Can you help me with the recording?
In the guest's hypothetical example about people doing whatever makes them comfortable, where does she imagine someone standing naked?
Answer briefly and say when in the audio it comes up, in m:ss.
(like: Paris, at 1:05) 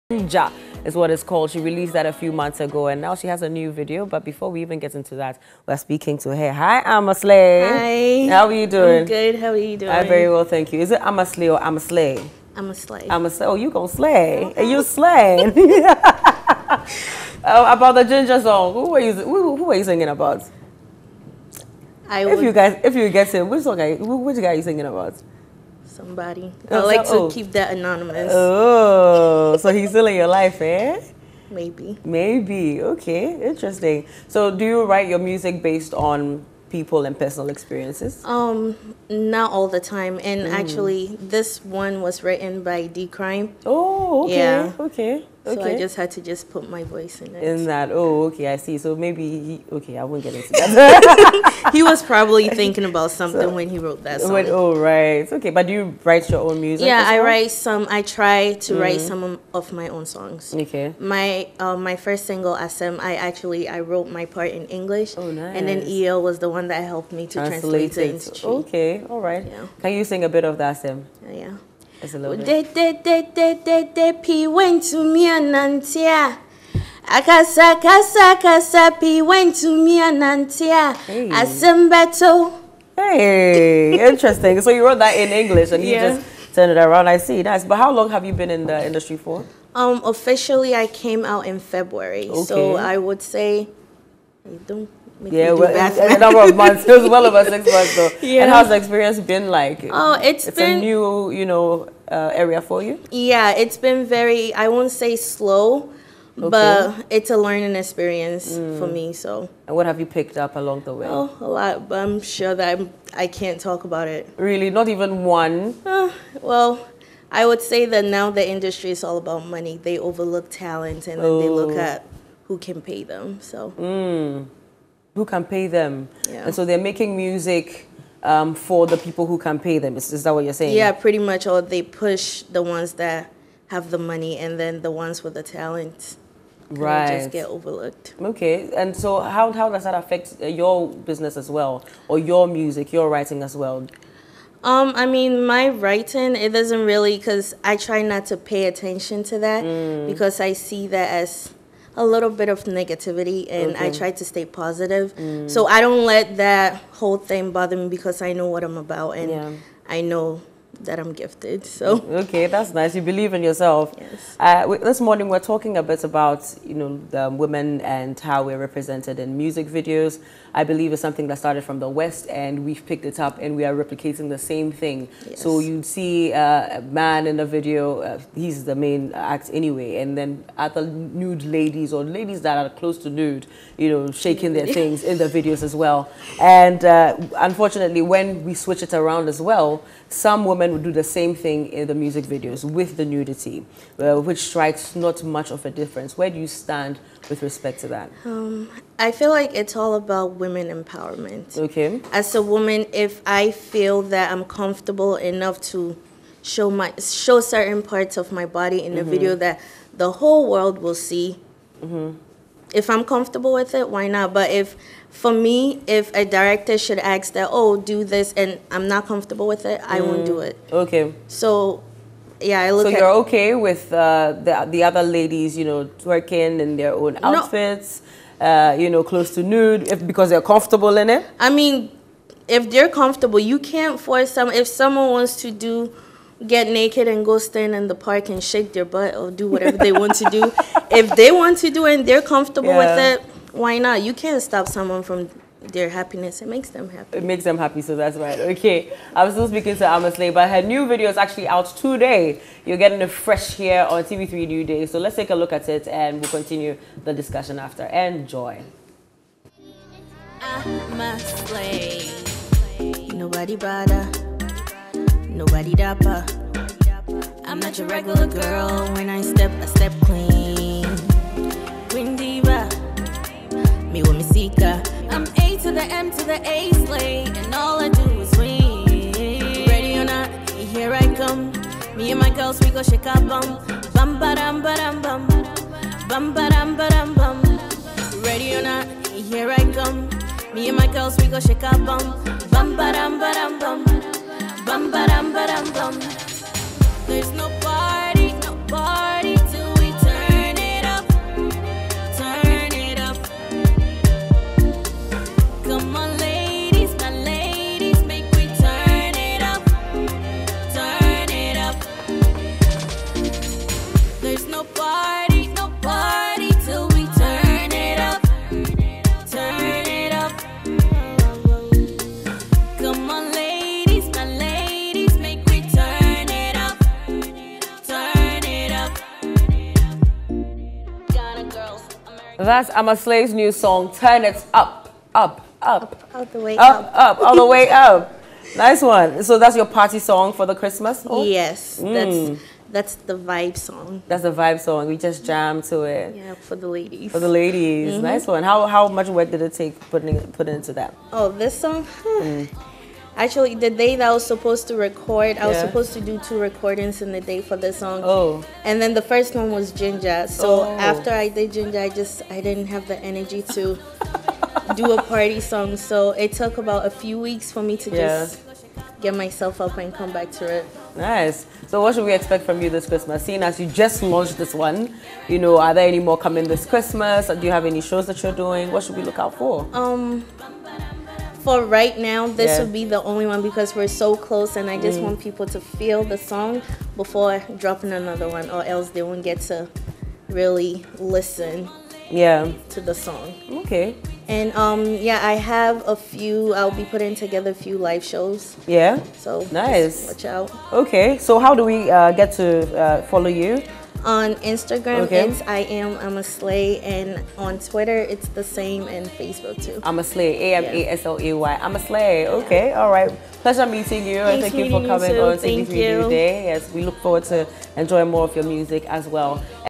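the park, at 3:57.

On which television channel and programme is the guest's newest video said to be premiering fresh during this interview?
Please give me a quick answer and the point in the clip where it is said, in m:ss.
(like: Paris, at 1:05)
TV3 New Day, at 4:14.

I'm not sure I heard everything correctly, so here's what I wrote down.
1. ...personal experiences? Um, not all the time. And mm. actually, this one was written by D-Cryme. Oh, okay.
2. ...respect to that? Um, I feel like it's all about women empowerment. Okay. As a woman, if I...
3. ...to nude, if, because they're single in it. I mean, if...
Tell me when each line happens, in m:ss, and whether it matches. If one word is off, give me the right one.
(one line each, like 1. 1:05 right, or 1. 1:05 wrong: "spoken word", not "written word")
1. 0:37 right
2. 3:17 right
3. 3:49 wrong: "comfortable", not "single".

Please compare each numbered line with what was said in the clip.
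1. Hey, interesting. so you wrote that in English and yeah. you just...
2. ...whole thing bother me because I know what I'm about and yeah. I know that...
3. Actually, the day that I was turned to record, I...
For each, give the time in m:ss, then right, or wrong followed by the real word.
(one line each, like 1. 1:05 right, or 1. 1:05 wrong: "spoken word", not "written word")
1. 1:22 right
2. 2:36 right
3. 5:53 wrong: "supposed", not "turned".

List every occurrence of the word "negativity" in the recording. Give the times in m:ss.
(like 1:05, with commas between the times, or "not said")
2:32.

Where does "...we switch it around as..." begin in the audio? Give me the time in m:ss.
3:08.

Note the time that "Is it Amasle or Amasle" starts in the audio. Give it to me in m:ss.
0:10.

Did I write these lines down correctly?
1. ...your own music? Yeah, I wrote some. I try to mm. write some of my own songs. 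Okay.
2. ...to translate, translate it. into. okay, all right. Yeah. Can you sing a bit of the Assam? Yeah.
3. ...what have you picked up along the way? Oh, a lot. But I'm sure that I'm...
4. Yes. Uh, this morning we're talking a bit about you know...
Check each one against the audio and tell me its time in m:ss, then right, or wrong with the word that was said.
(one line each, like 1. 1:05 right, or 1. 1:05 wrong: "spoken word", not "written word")
1. 0:56 wrong: "write", not "wrote"
2. 1:07 right
3. 1:49 right
4. 2:43 right.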